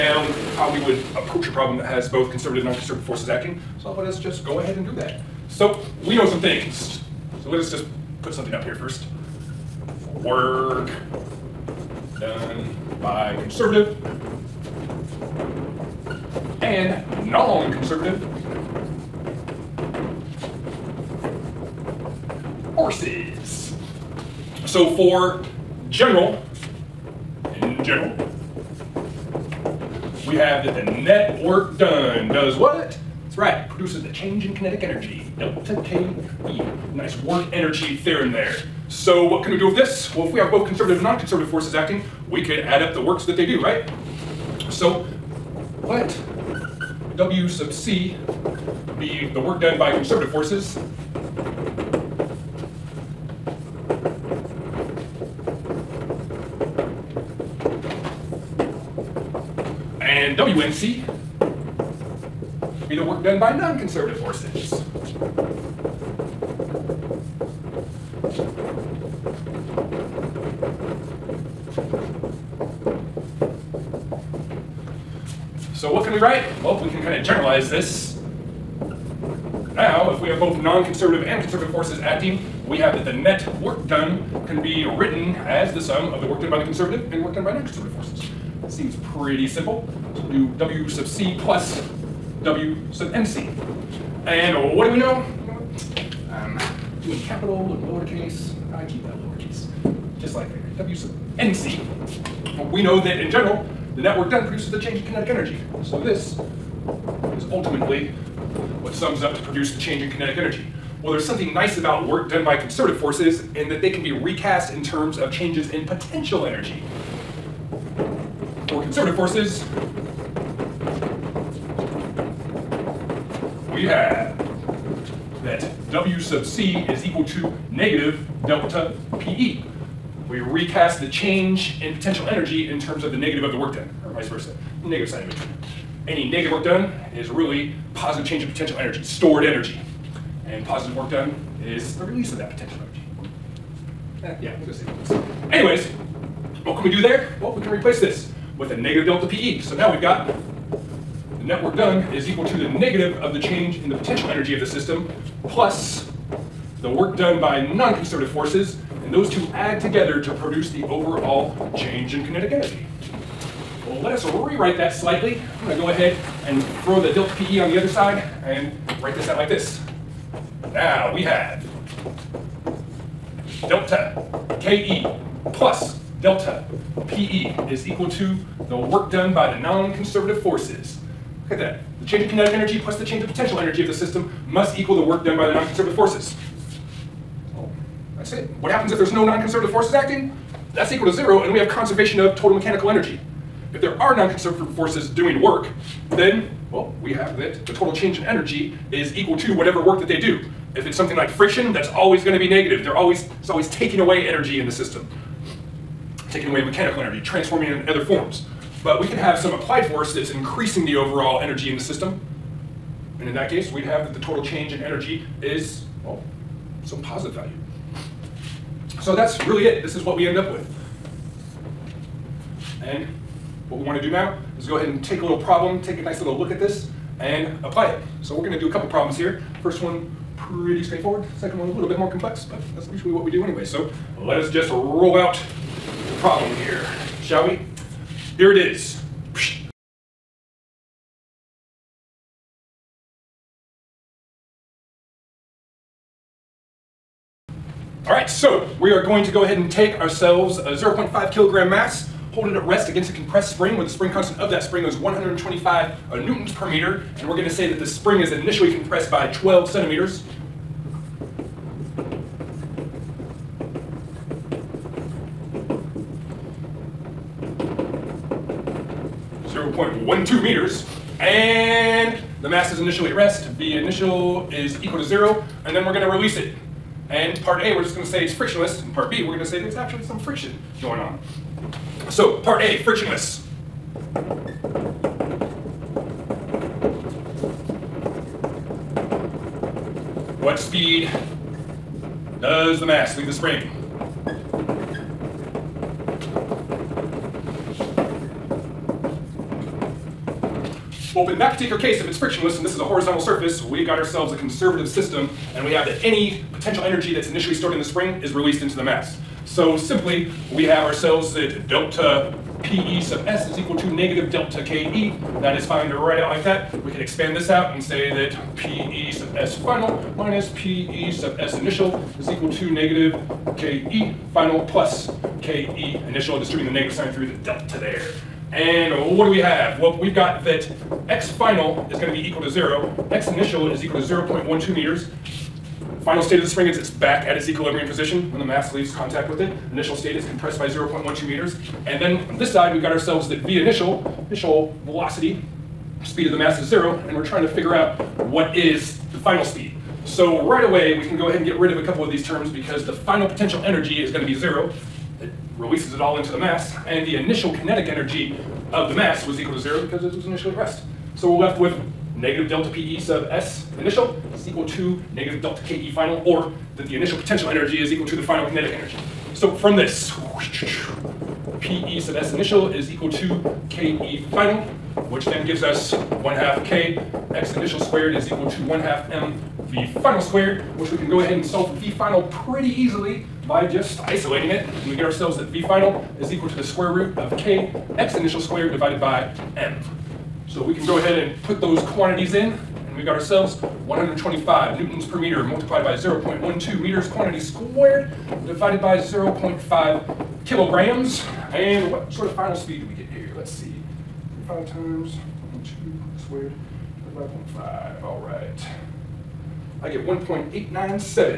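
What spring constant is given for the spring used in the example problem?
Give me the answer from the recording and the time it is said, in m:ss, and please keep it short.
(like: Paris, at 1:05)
125 N/m, at 4:14.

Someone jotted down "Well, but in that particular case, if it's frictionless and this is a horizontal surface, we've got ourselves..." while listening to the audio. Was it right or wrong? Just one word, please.
right.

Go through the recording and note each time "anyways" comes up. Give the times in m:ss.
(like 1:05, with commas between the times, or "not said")
2:25, 3:53.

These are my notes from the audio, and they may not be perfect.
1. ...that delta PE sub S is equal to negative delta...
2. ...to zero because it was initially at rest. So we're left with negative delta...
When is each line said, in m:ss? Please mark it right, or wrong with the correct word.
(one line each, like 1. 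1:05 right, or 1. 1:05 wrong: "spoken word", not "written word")
1. 5:11 right
2. 5:59 right.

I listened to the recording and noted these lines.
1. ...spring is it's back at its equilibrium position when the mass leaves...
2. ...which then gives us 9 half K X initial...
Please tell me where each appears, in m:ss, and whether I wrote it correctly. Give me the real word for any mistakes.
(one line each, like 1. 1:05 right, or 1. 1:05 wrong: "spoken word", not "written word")
1. 5:36 right
2. 6:15 wrong: "1", not "9".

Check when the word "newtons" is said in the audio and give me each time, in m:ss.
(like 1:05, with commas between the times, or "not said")
4:16, 6:34.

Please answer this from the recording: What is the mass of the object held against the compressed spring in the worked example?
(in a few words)
0.5 kg.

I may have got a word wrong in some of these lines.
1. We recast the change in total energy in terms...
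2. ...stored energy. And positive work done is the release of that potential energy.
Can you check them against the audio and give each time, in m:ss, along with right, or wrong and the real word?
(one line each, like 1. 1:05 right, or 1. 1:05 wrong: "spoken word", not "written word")
1. 2:10 wrong: "potential", not "total"
2. 2:19 right.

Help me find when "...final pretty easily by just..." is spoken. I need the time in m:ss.
6:21.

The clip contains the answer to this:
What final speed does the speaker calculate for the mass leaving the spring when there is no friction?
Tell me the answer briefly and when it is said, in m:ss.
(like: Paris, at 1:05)
1.897, at 6:50.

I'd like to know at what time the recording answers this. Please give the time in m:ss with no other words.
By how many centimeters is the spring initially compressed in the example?
4:19.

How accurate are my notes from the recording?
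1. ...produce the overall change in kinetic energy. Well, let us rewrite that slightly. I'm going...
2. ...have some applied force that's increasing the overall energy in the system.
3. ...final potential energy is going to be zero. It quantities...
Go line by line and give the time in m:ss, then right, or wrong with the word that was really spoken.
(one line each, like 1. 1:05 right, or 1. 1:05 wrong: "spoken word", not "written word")
1. 2:40 right
2. 3:29 right
3. 5:52 wrong: "releases", not "quantities".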